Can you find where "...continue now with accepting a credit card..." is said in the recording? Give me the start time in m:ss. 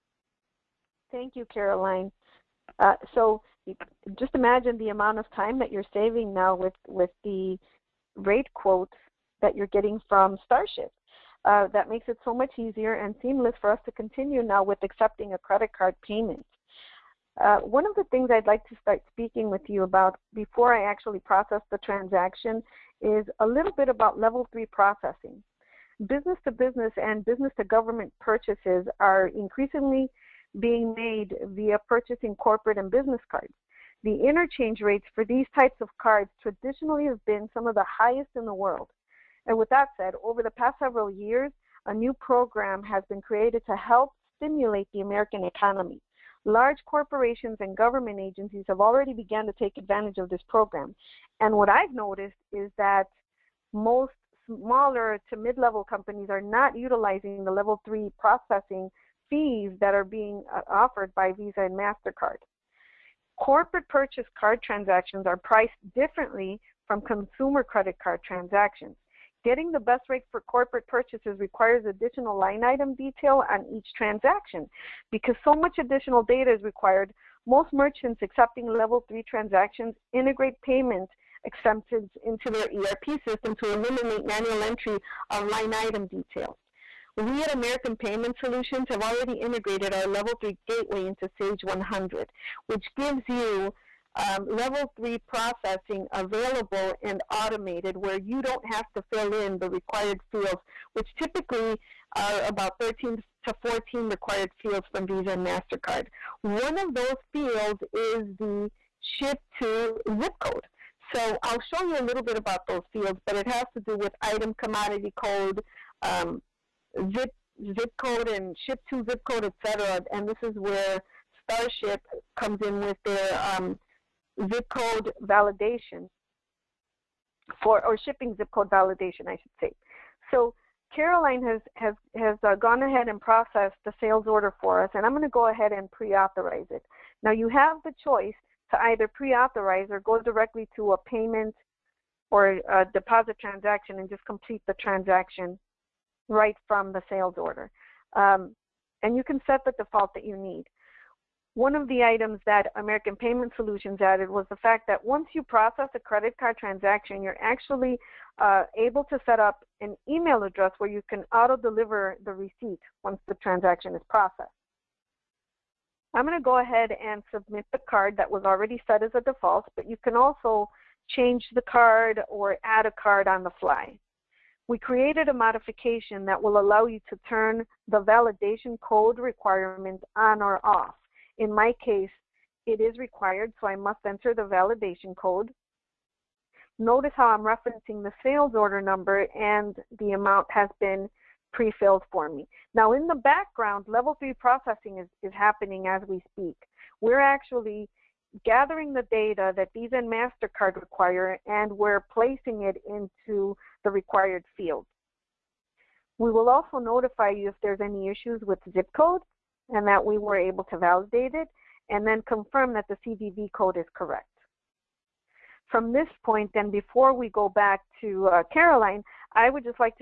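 0:13.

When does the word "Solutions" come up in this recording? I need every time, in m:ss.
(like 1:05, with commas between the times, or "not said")
1:28, 2:33.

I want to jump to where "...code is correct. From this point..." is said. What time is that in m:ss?
3:33.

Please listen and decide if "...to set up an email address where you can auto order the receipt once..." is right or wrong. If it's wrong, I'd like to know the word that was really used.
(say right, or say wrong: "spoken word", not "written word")
wrong: "deliver", not "order".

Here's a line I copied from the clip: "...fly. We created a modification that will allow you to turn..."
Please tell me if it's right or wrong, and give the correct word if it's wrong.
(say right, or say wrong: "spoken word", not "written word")
right.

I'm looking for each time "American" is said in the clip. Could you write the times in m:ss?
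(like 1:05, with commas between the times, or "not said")
0:45, 1:27, 2:32.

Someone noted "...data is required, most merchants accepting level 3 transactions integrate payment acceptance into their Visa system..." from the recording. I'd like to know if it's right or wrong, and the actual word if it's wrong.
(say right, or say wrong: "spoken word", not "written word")
wrong: "ERP", not "Visa".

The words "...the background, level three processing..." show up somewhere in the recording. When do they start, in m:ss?
3:13.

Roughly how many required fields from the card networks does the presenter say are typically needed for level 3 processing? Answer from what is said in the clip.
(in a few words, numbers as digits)
13 to 14.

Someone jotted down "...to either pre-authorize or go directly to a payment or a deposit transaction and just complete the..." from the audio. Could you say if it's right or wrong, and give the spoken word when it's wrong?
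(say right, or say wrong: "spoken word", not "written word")
right.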